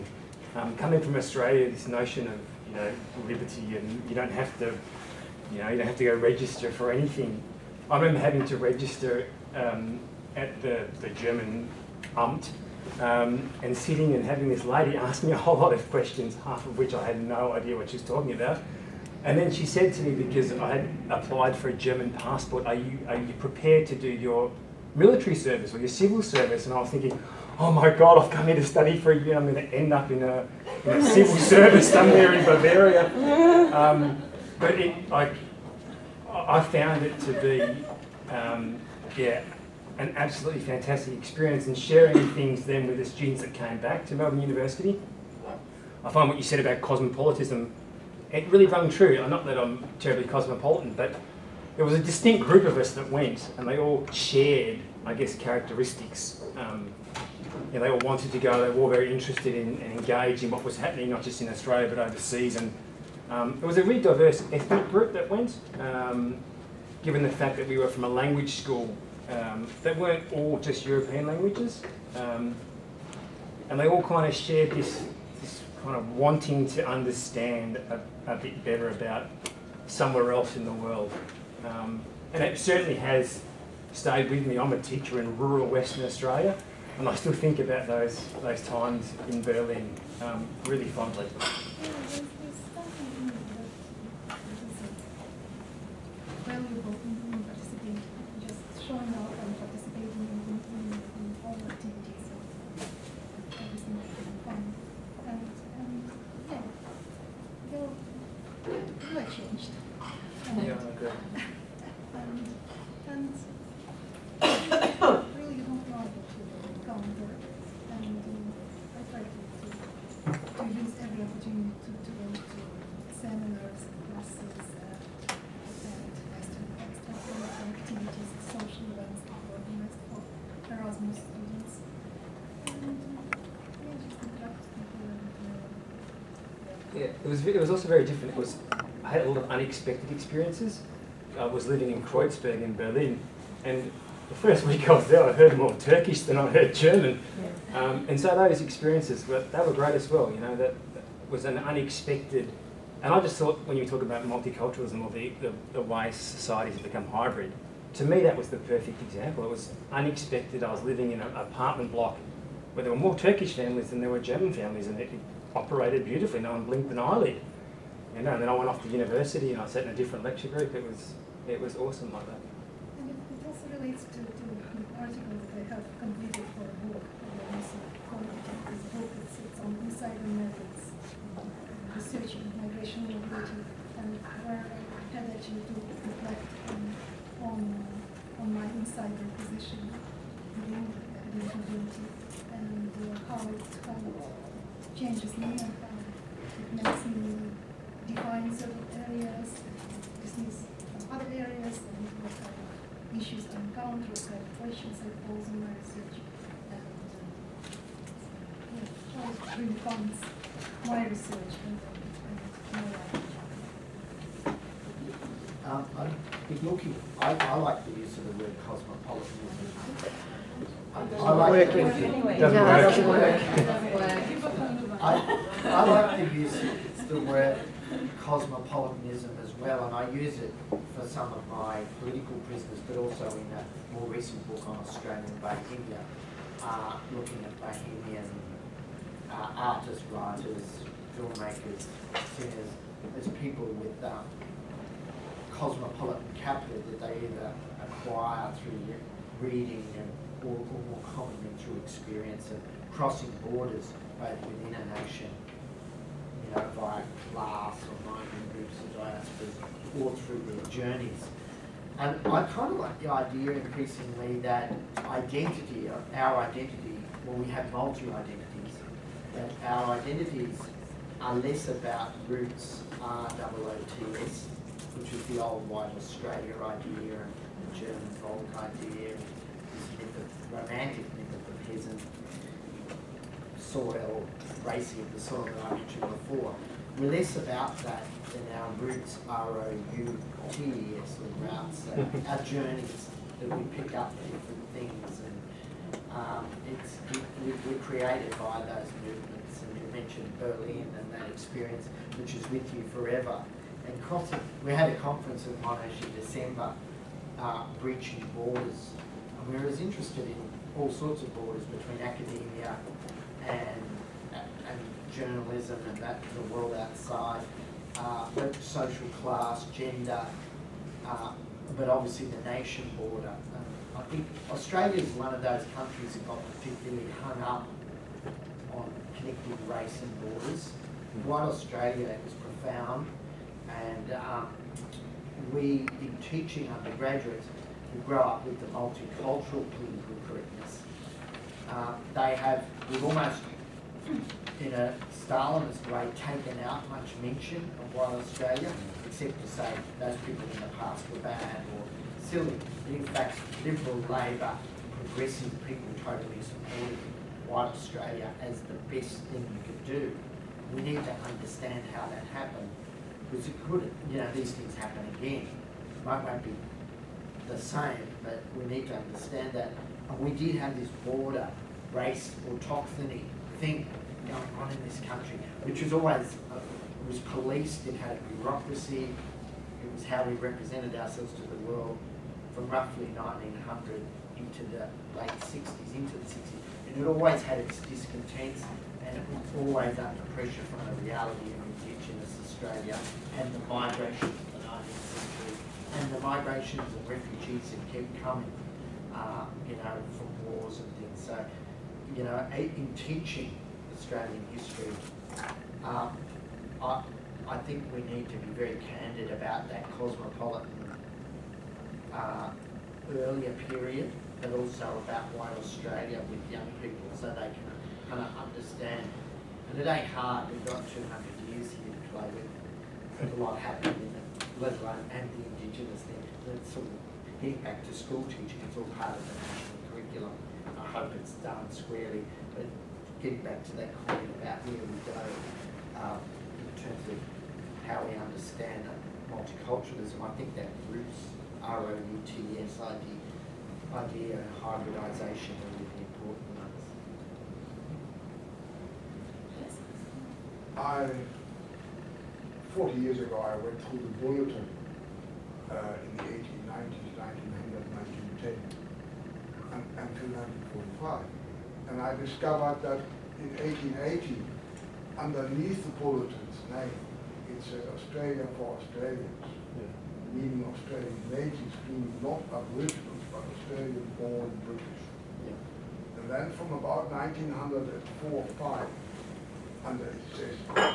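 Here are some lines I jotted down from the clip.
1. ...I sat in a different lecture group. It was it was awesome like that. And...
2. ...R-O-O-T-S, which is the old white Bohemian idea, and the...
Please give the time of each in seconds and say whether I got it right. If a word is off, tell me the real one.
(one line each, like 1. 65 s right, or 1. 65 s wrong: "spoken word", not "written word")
1. 169 s right
2. 273 s wrong: "Australia", not "Bohemian".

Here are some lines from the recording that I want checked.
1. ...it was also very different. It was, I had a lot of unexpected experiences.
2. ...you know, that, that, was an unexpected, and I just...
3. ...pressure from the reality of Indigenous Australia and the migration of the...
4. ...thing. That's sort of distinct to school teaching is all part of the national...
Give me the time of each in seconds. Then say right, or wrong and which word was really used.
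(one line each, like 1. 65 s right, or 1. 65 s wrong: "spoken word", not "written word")
1. 137 s right
2. 150 s right
3. 390 s right
4. 426 s wrong: "impact", not "distinct".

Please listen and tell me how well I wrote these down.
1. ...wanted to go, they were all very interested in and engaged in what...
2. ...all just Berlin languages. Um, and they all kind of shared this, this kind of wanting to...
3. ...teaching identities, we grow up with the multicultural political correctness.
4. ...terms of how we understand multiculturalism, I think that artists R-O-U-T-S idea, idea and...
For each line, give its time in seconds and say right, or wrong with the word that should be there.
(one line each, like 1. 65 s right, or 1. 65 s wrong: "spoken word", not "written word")
1. 57 s right
2. 70 s wrong: "European", not "Berlin"
3. 336 s wrong: "undergraduates", not "identities"
4. 436 s wrong: "roots", not "artists".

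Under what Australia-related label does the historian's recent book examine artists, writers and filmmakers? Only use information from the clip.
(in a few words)
Australian Bohemia.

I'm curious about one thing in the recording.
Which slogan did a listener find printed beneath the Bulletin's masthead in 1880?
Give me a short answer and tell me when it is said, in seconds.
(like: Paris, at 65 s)
Australia for Australians, at 467 s.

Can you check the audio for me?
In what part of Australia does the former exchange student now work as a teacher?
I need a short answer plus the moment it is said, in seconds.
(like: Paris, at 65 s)
rural Western Australia, at 85 s.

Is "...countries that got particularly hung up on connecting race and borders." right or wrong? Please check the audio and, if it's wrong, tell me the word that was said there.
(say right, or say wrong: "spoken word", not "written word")
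right.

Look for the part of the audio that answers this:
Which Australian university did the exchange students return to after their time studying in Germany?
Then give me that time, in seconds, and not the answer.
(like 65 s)
44 s.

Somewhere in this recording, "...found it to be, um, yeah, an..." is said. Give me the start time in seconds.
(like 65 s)
36 s.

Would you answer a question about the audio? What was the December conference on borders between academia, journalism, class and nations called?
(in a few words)
Breaching borders.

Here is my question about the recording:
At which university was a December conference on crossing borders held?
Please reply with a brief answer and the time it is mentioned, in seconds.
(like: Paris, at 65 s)
Monash, at 305 s.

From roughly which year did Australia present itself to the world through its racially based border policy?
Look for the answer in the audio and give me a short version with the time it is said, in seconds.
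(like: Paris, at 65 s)
1900, at 383 s.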